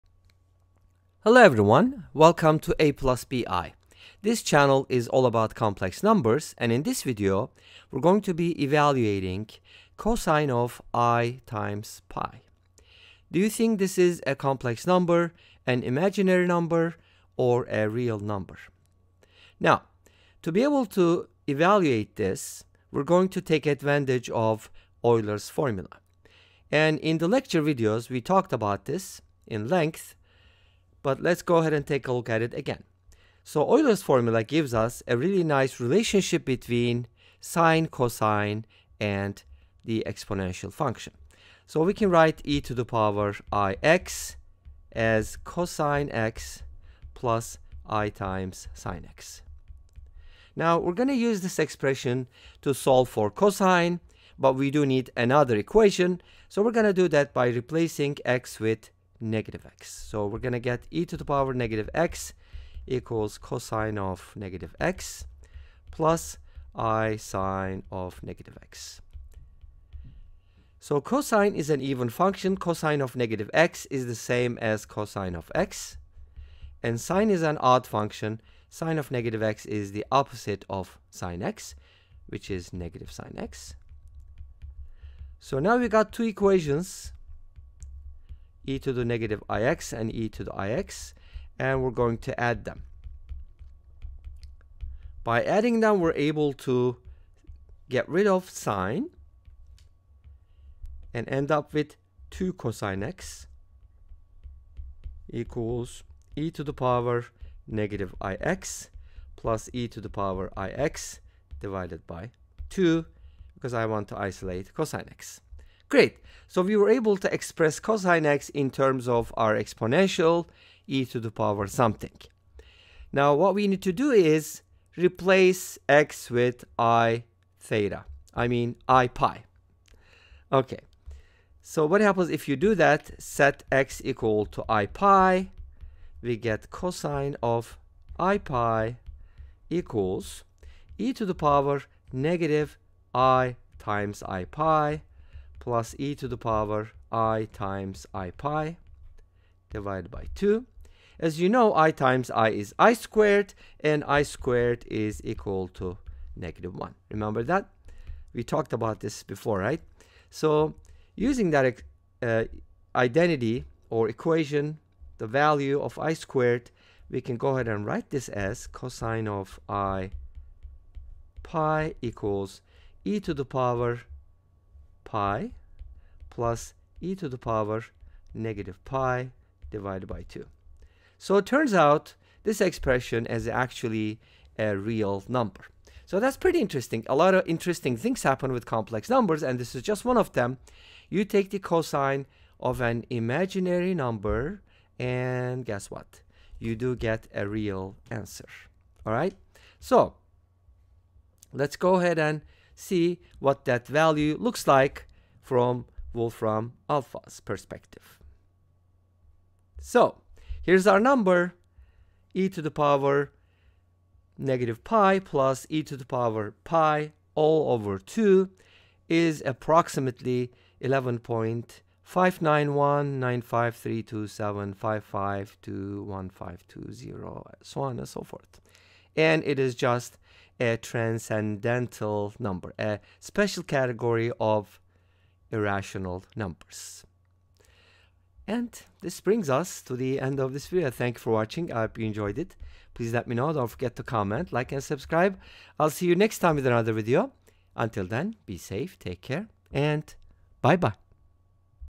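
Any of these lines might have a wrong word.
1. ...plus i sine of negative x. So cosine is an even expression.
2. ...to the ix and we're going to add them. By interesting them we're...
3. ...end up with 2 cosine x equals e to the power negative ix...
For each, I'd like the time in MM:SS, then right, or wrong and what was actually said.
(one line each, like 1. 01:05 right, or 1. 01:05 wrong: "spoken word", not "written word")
1. 01:05 wrong: "function", not "expression"
2. 01:30 wrong: "adding", not "interesting"
3. 01:41 right.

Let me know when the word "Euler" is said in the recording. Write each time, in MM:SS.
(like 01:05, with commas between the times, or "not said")
00:25, 00:33.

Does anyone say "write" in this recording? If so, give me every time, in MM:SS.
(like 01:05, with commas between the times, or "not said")
00:42, 02:47.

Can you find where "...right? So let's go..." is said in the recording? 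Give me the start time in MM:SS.
03:19.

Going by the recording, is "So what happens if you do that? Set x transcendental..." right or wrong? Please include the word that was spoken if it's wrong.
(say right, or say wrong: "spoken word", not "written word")
wrong: "equal", not "transcendental".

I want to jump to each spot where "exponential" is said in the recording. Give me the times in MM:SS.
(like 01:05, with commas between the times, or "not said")
00:40, 01:59.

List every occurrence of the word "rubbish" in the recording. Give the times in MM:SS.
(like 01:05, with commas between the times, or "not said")
not said.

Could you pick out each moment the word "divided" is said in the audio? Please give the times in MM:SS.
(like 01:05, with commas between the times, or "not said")
01:51, 02:29, 02:59.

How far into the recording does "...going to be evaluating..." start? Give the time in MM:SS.
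00:08.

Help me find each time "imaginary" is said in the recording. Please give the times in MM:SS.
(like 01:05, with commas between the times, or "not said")
00:15, 03:13.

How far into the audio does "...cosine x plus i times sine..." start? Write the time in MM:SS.
00:45.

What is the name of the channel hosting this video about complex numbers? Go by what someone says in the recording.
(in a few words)
A plus BI.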